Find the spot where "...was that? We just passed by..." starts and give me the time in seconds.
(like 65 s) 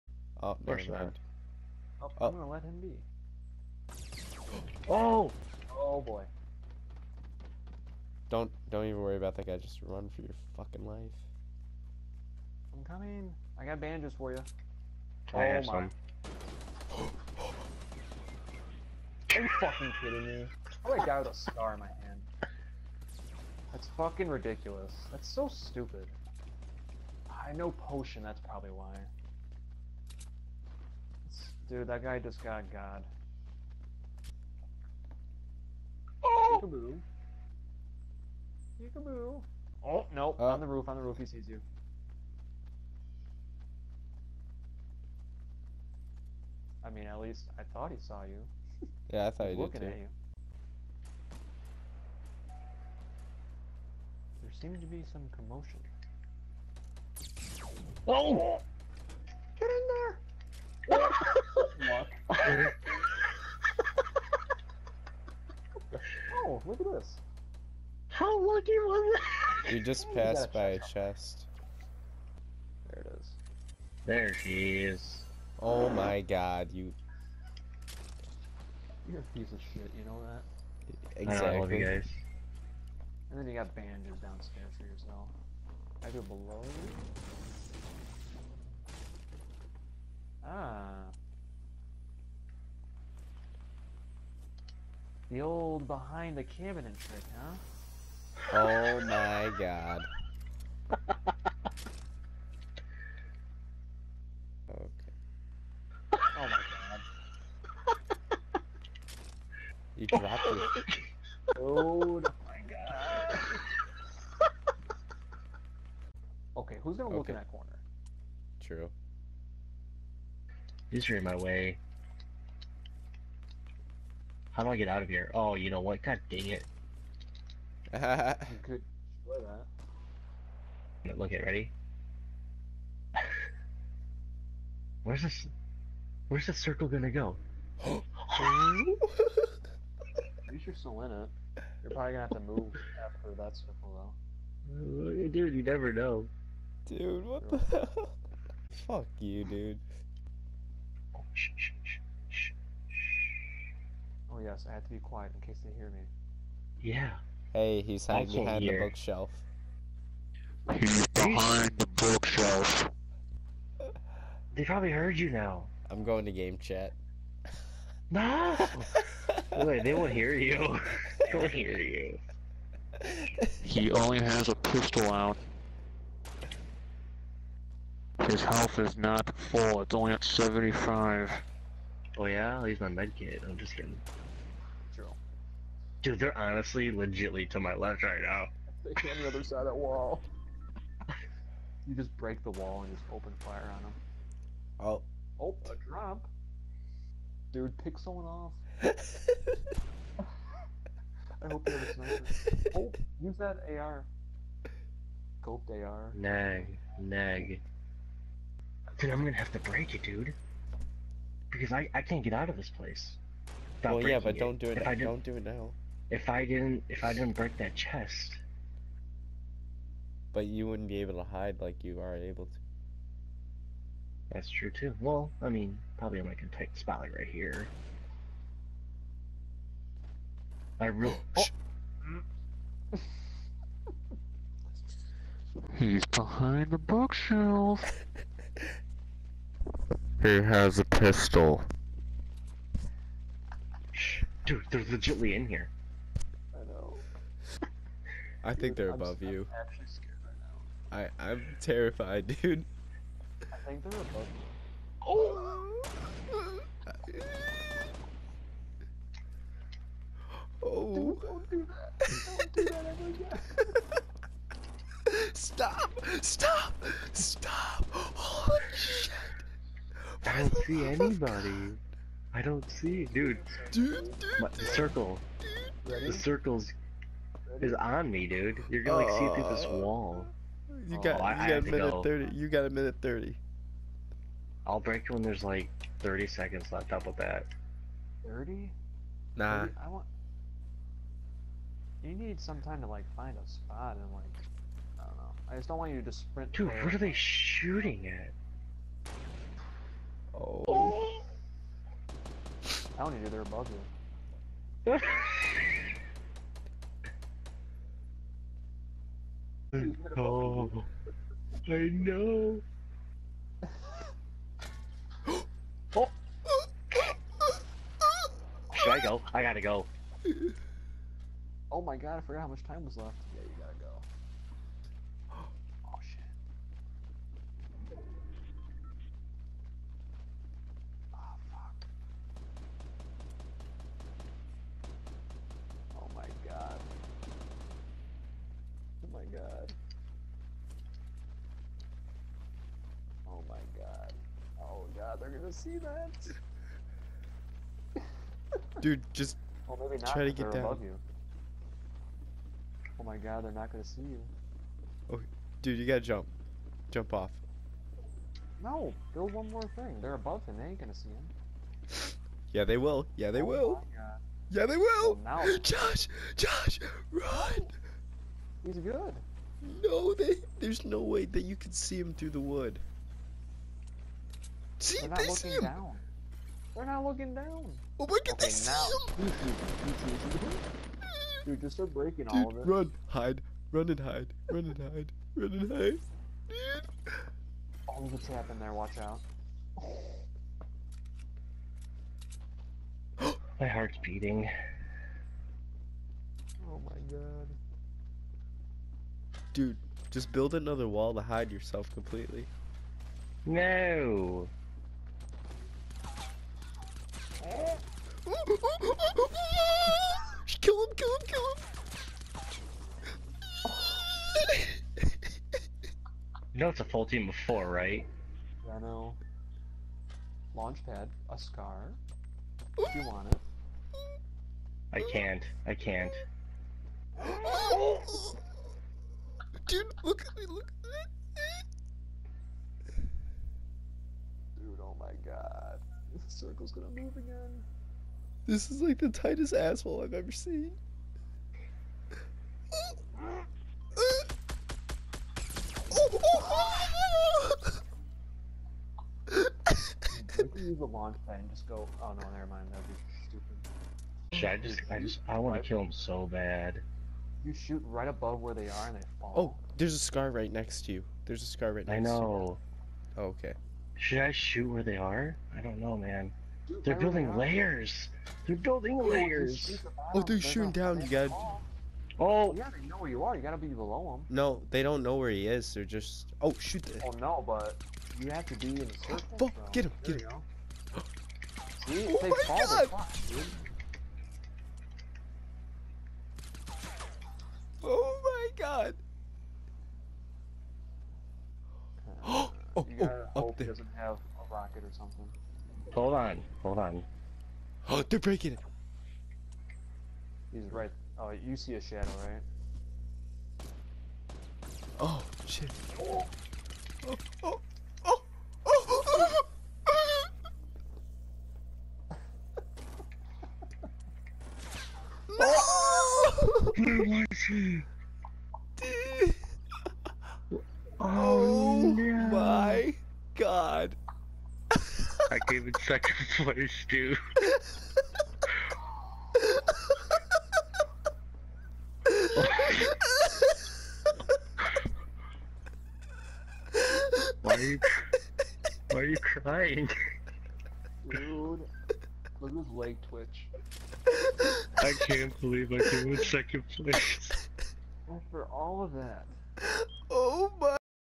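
68 s.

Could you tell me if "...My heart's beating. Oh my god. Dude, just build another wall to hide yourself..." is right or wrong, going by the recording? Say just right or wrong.
right.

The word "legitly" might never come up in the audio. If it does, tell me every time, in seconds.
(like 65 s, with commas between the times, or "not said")
186 s, 244 s.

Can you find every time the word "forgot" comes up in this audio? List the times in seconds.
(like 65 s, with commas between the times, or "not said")
322 s.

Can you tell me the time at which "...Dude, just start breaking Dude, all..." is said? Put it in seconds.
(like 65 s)
381 s.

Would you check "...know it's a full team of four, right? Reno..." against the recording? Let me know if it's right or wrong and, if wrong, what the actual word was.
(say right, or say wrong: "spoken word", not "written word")
right.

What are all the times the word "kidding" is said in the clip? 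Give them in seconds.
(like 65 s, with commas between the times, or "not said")
20 s, 183 s.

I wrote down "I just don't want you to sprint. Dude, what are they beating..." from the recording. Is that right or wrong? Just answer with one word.
wrong.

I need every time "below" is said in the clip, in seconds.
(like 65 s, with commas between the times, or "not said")
86 s, 473 s.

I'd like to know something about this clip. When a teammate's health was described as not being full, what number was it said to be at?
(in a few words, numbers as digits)
75.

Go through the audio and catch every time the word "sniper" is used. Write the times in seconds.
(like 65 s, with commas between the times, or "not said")
201 s.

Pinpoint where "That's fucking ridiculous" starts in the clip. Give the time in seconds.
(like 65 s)
23 s.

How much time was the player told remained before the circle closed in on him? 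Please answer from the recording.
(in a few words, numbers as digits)
a minute thirty.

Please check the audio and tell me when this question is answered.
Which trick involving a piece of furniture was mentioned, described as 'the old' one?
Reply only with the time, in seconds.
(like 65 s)
95 s.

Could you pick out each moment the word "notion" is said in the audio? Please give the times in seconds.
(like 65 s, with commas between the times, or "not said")
not said.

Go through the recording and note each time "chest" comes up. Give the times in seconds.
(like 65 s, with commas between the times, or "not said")
70 s, 217 s.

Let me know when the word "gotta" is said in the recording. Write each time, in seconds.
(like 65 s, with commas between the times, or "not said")
319 s, 355 s, 473 s, 492 s.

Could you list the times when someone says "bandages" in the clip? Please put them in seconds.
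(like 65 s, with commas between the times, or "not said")
13 s, 83 s.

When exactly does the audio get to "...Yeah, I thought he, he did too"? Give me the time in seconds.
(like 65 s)
49 s.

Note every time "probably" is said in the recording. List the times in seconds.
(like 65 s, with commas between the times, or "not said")
28 s, 141 s, 164 s, 225 s.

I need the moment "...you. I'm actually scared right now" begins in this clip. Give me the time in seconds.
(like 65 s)
249 s.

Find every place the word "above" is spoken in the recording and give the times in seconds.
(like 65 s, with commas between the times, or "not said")
248 s, 253 s, 303 s, 360 s, 458 s.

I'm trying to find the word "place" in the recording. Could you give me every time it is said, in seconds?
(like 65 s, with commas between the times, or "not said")
212 s, 526 s, 546 s.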